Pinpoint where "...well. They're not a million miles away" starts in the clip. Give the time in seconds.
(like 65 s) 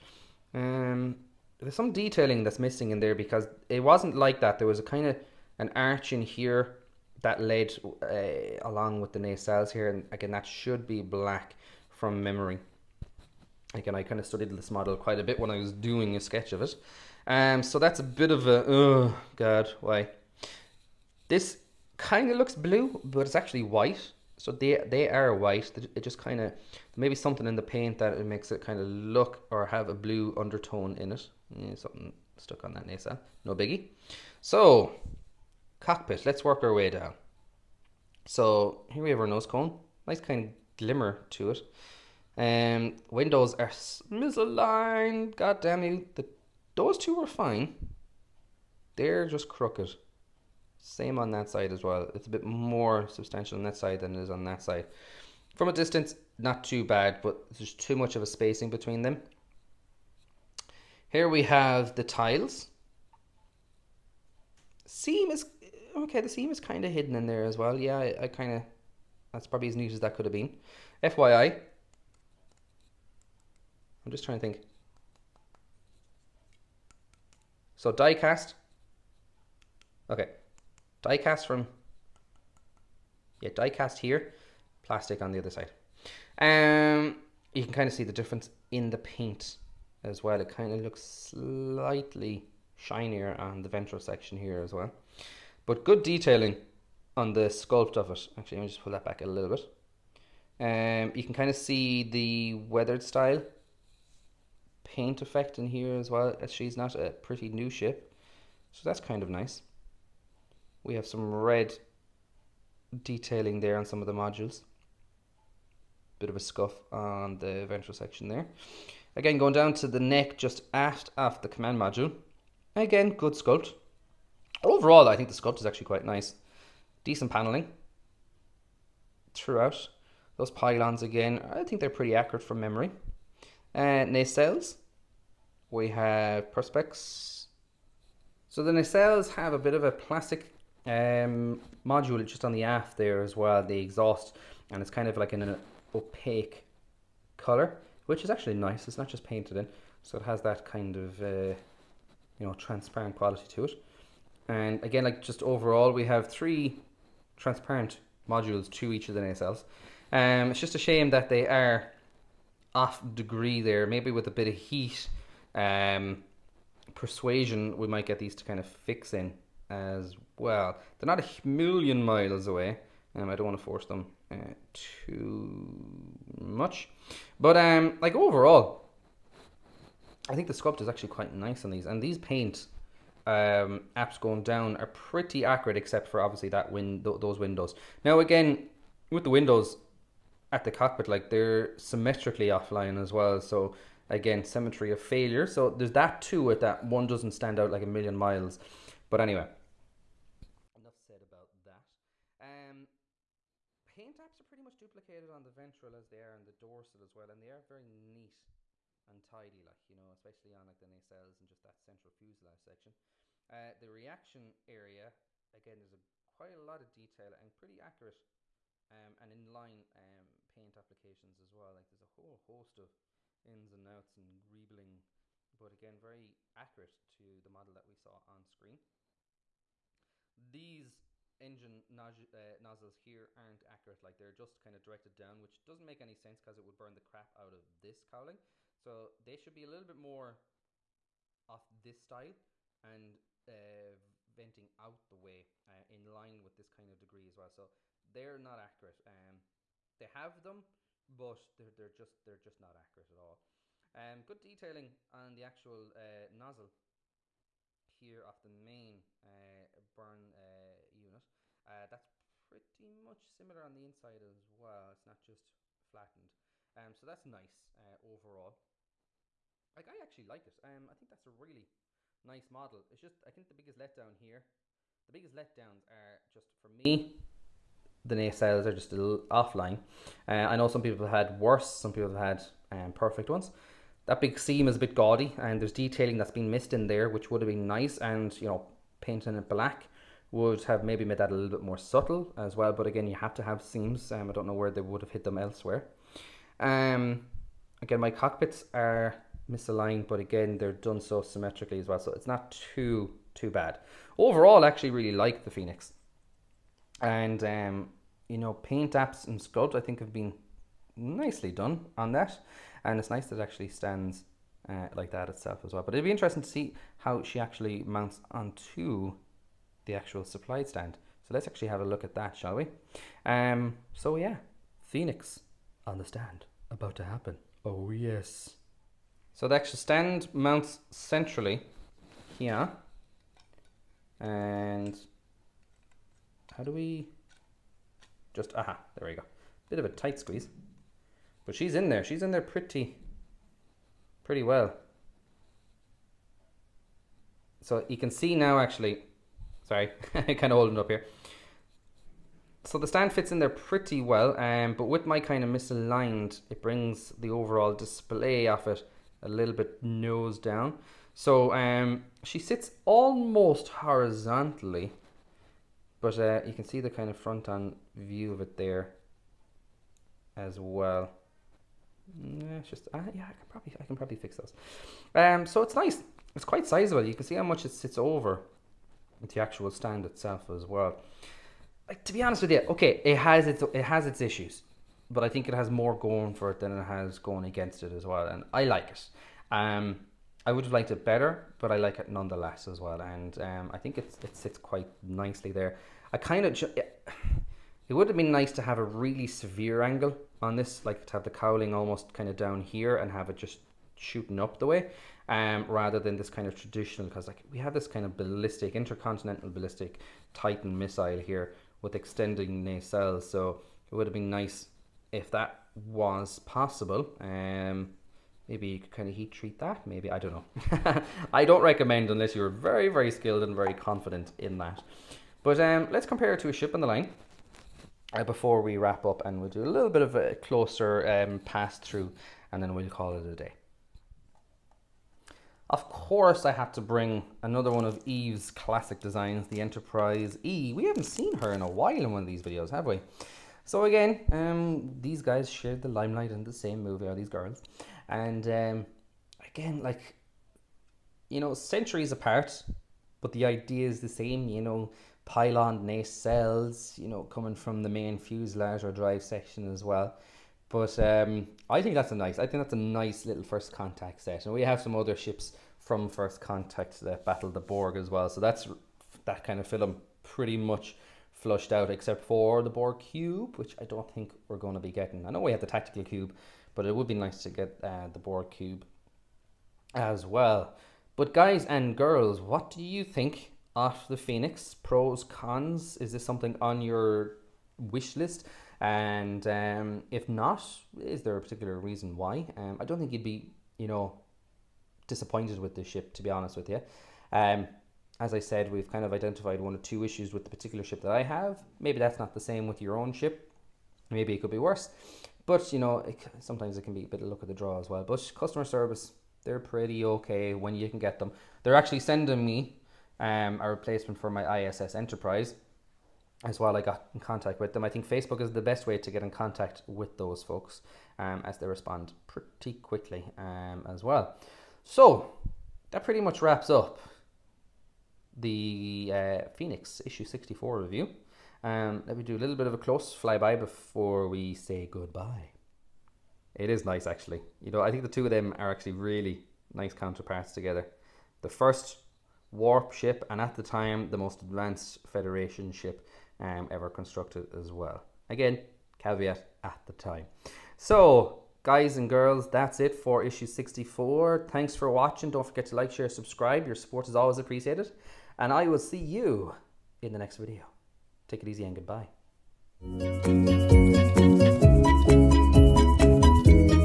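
170 s.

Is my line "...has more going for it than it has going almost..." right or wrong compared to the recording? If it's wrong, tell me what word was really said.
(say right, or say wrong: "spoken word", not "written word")
wrong: "against", not "almost".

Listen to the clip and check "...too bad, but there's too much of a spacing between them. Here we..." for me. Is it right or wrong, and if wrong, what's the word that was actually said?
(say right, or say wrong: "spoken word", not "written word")
right.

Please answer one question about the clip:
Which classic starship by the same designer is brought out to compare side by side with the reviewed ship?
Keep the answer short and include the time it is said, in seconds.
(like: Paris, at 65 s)
Enterprise E, at 439 s.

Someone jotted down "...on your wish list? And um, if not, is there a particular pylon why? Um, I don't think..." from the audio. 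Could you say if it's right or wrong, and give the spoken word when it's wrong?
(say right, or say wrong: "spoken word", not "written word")
wrong: "reason", not "pylon".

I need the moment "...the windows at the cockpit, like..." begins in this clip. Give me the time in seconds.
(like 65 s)
189 s.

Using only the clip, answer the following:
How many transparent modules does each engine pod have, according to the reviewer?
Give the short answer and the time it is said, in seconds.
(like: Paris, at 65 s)
3, at 156 s.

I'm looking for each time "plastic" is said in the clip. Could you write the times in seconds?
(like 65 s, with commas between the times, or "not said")
84 s, 139 s.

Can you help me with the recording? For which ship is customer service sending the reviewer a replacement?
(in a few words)
ISS Enterprise.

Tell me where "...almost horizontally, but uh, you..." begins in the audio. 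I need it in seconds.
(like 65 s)
362 s.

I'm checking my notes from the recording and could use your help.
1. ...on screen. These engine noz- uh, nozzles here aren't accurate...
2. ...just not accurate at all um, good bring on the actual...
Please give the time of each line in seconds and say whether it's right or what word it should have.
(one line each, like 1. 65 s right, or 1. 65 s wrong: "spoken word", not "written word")
1. 228 s right
2. 252 s wrong: "detailing", not "bring".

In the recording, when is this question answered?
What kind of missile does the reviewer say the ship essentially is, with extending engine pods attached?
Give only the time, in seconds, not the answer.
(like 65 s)
410 s.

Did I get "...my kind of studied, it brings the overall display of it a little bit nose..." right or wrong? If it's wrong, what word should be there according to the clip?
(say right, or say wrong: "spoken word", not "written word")
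wrong: "misaligned", not "studied".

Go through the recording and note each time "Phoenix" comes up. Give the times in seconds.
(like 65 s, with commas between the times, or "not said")
305 s, 324 s, 484 s, 529 s.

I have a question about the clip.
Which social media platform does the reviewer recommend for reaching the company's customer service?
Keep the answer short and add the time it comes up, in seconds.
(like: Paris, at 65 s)
Facebook, at 518 s.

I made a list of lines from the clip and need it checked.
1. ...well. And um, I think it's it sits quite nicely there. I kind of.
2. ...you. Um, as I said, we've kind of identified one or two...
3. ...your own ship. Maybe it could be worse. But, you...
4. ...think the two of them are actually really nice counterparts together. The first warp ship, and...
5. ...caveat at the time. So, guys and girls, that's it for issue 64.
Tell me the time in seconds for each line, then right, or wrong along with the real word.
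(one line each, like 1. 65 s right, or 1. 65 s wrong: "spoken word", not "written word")
1. 392 s right
2. 496 s right
3. 502 s right
4. 537 s right
5. 548 s right.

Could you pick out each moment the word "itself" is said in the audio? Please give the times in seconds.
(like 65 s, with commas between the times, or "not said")
315 s, 380 s.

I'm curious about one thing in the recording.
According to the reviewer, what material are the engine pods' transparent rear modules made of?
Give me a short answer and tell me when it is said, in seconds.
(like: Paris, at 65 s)
Perspex, at 136 s.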